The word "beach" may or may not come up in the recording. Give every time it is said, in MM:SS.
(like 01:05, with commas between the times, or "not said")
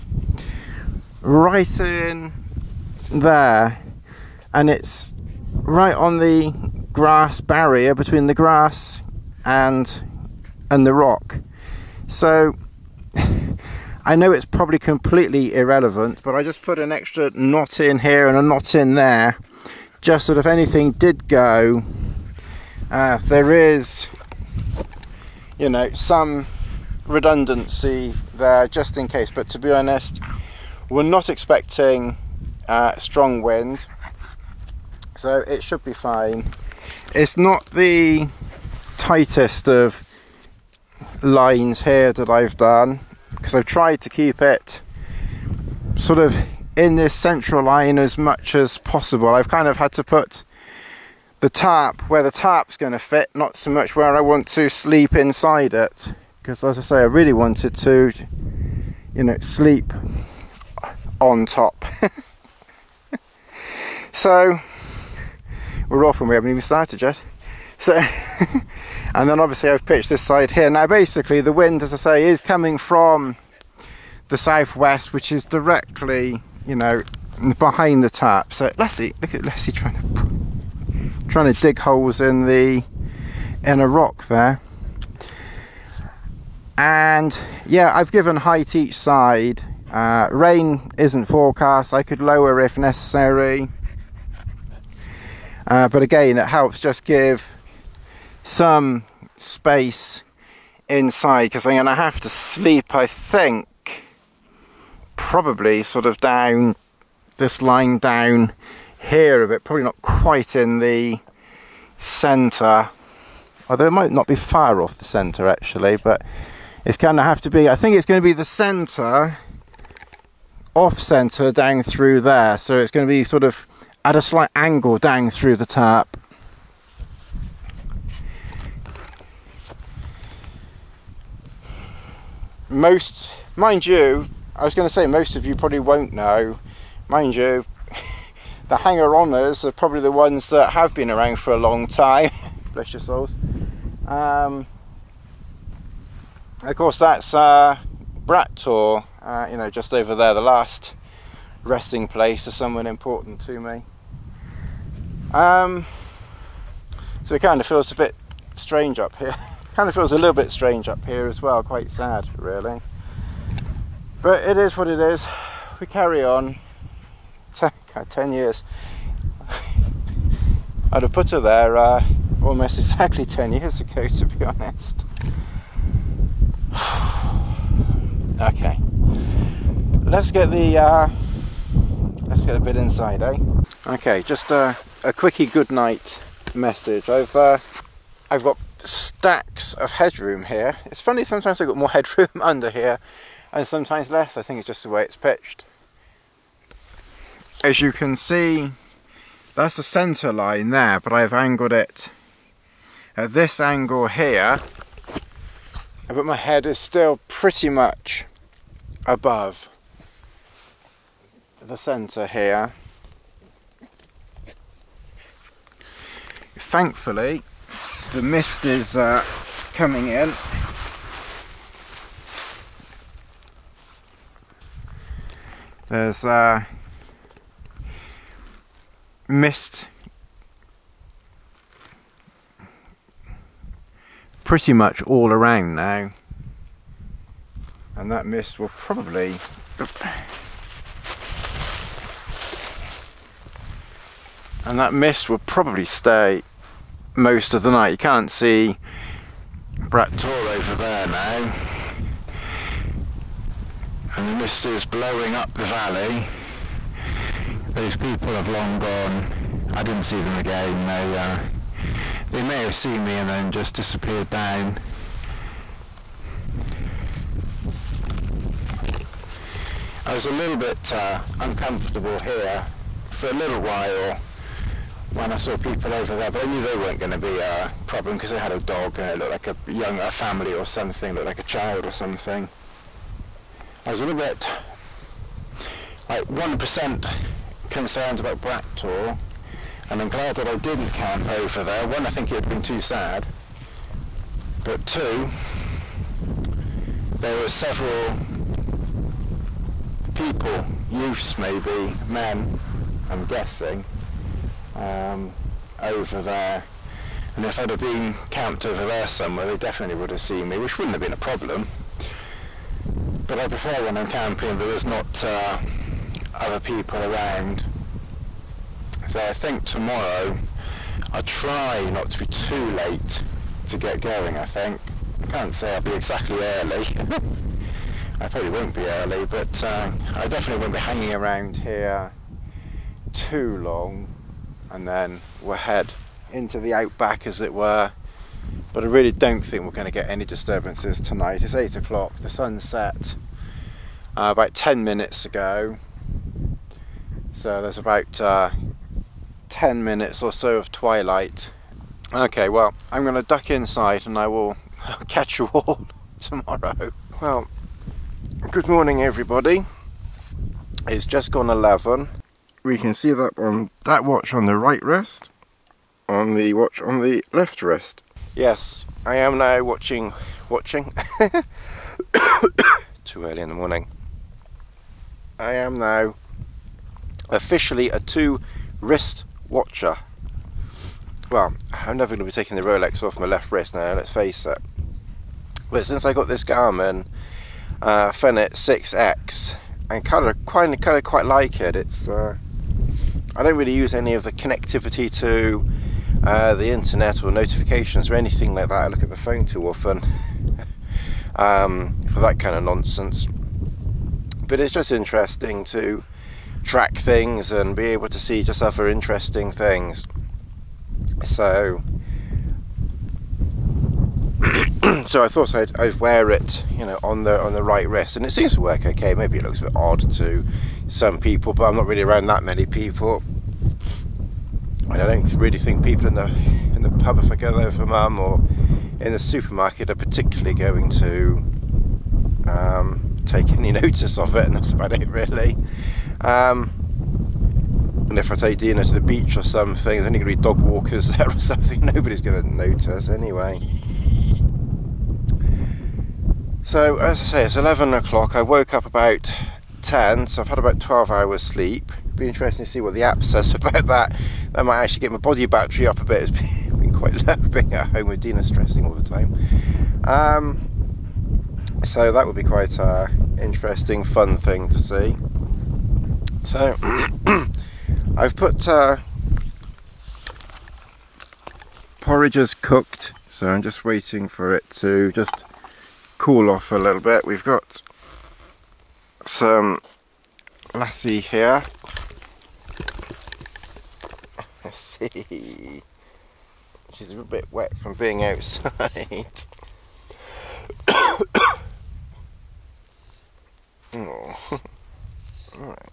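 07:19.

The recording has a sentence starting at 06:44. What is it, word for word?
But it's just interesting to track things and be able to see just other interesting things.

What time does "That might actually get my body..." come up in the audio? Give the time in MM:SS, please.
07:34.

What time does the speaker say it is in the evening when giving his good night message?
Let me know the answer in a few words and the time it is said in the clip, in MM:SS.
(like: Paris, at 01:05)
8 o'clock, at 05:41.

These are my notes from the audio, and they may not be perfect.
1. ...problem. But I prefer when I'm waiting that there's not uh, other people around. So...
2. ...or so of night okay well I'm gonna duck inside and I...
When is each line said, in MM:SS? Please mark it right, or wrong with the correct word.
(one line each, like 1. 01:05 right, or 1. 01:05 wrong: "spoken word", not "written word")
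1. 05:11 wrong: "camping", not "waiting"
2. 05:50 wrong: "twilight", not "night".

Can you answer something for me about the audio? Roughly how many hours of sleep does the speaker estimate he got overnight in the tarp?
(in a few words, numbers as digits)
12.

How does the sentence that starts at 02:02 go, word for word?
So it's going to be sort of at a slight angle down through the tap.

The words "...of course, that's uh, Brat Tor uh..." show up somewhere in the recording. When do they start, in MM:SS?
02:26.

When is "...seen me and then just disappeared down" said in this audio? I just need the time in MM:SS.
04:22.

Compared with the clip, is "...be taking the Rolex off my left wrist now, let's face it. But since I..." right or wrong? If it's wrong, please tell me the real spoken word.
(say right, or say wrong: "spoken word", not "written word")
right.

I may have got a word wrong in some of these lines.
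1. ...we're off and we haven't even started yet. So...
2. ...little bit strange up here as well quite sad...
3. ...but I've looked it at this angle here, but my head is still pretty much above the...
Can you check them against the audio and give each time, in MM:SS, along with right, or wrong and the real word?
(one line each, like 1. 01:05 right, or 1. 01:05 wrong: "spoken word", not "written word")
1. 01:05 right
2. 02:40 right
3. 03:21 wrong: "angled", not "looked".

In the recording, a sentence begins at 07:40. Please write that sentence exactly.
Um, so that would be quite an uh, interesting, fun thing to see.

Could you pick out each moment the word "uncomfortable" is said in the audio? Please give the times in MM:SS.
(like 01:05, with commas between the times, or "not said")
04:31.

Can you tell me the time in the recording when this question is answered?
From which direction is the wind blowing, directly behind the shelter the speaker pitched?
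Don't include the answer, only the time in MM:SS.
01:14.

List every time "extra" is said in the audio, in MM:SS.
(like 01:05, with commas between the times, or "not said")
00:16.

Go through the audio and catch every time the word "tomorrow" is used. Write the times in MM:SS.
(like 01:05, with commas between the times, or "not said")
05:19, 05:56.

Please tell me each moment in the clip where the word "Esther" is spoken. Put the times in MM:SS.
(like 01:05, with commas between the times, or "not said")
not said.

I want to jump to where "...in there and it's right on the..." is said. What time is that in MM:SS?
00:01.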